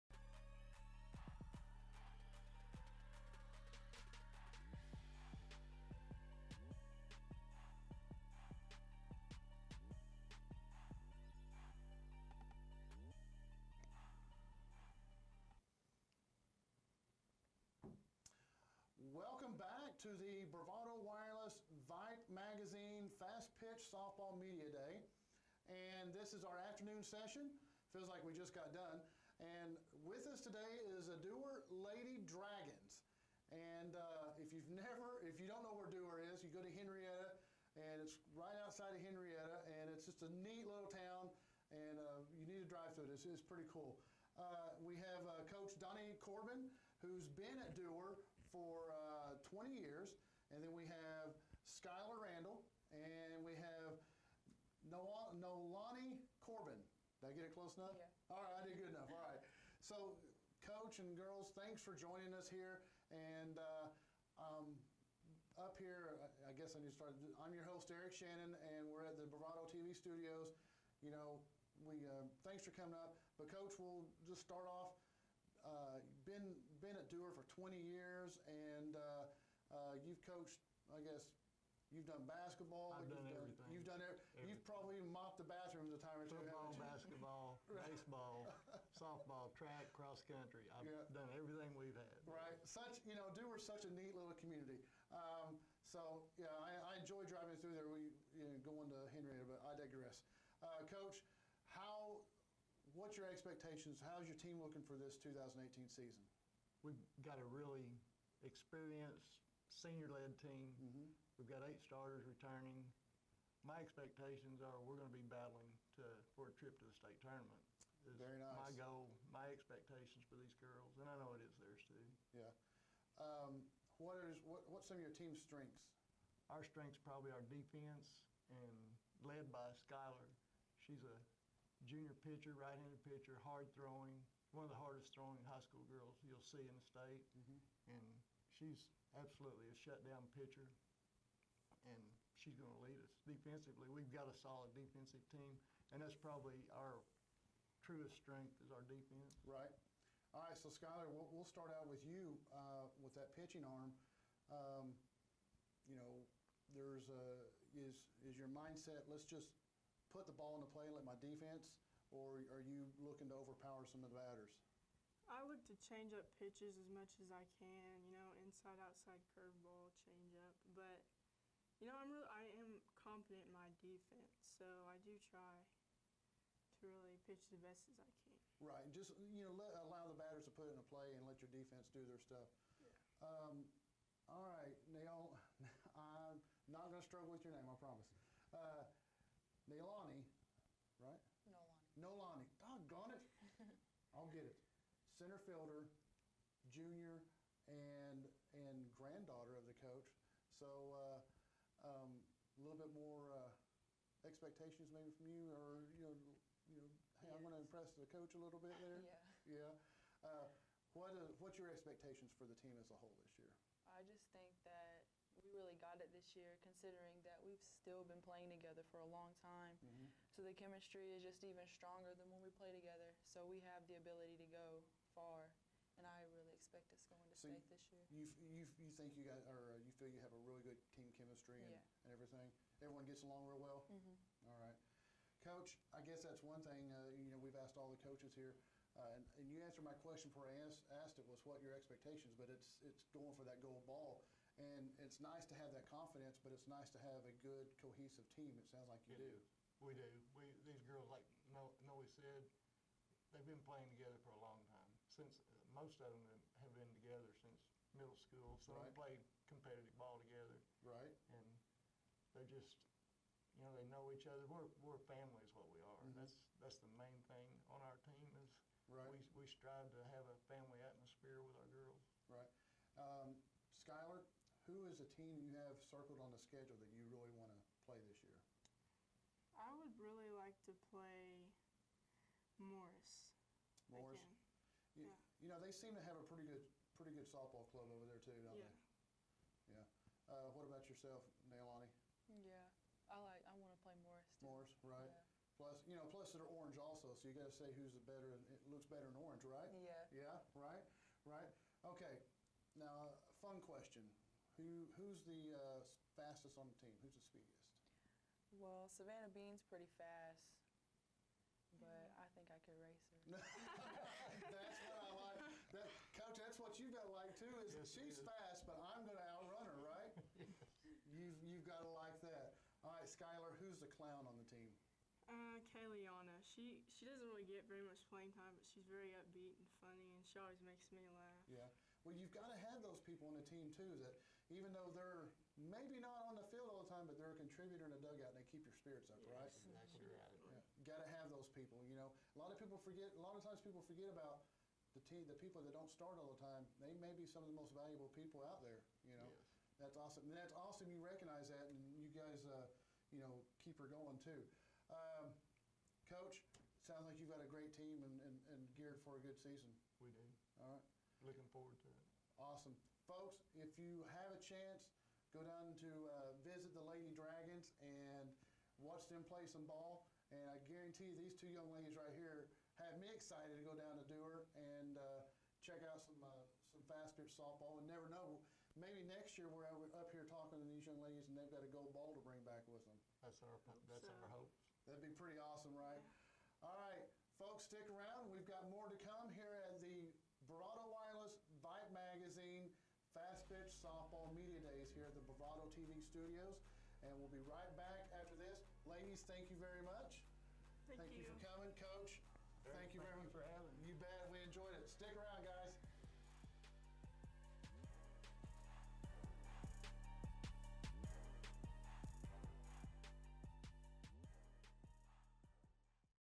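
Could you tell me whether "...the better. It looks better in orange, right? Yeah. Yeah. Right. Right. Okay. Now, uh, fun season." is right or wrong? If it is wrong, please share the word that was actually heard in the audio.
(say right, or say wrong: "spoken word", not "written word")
wrong: "question", not "season".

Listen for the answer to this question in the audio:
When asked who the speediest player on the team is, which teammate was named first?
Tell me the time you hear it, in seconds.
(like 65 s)
308 s.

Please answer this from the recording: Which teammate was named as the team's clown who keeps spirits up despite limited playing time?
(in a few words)
Kayliana.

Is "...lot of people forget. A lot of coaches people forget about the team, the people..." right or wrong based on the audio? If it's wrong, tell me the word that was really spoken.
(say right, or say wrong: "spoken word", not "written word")
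wrong: "times", not "coaches".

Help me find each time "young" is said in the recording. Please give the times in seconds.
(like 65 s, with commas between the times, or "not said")
371 s, 380 s.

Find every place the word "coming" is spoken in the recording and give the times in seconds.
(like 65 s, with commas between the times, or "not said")
72 s, 401 s.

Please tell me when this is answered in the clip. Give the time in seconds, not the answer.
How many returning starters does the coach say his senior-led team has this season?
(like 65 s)
111 s.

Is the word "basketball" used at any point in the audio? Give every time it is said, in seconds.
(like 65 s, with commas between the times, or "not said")
82 s, 86 s.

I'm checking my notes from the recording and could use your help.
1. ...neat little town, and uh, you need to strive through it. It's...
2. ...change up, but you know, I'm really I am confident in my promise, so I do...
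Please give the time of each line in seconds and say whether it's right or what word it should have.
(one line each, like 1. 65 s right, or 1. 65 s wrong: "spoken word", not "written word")
1. 40 s wrong: "drive", not "strive"
2. 170 s wrong: "defense", not "promise".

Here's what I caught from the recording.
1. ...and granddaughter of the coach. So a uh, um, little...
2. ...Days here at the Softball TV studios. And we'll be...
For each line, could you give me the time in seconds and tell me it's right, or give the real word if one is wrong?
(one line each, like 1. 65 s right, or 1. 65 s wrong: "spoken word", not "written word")
1. 198 s right
2. 394 s wrong: "Bravado", not "Softball".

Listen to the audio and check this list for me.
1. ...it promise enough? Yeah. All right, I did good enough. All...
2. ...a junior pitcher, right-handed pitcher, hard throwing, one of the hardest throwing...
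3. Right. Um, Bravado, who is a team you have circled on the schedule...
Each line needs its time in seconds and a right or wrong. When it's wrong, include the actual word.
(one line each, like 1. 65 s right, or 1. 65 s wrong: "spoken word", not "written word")
1. 57 s wrong: "close", not "promise"
2. 131 s right
3. 272 s wrong: "Skyler", not "Bravado".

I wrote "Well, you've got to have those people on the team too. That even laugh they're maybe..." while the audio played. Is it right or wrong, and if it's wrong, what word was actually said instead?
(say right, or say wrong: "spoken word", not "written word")
wrong: "though", not "laugh".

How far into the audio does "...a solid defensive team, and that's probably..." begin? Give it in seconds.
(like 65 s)
144 s.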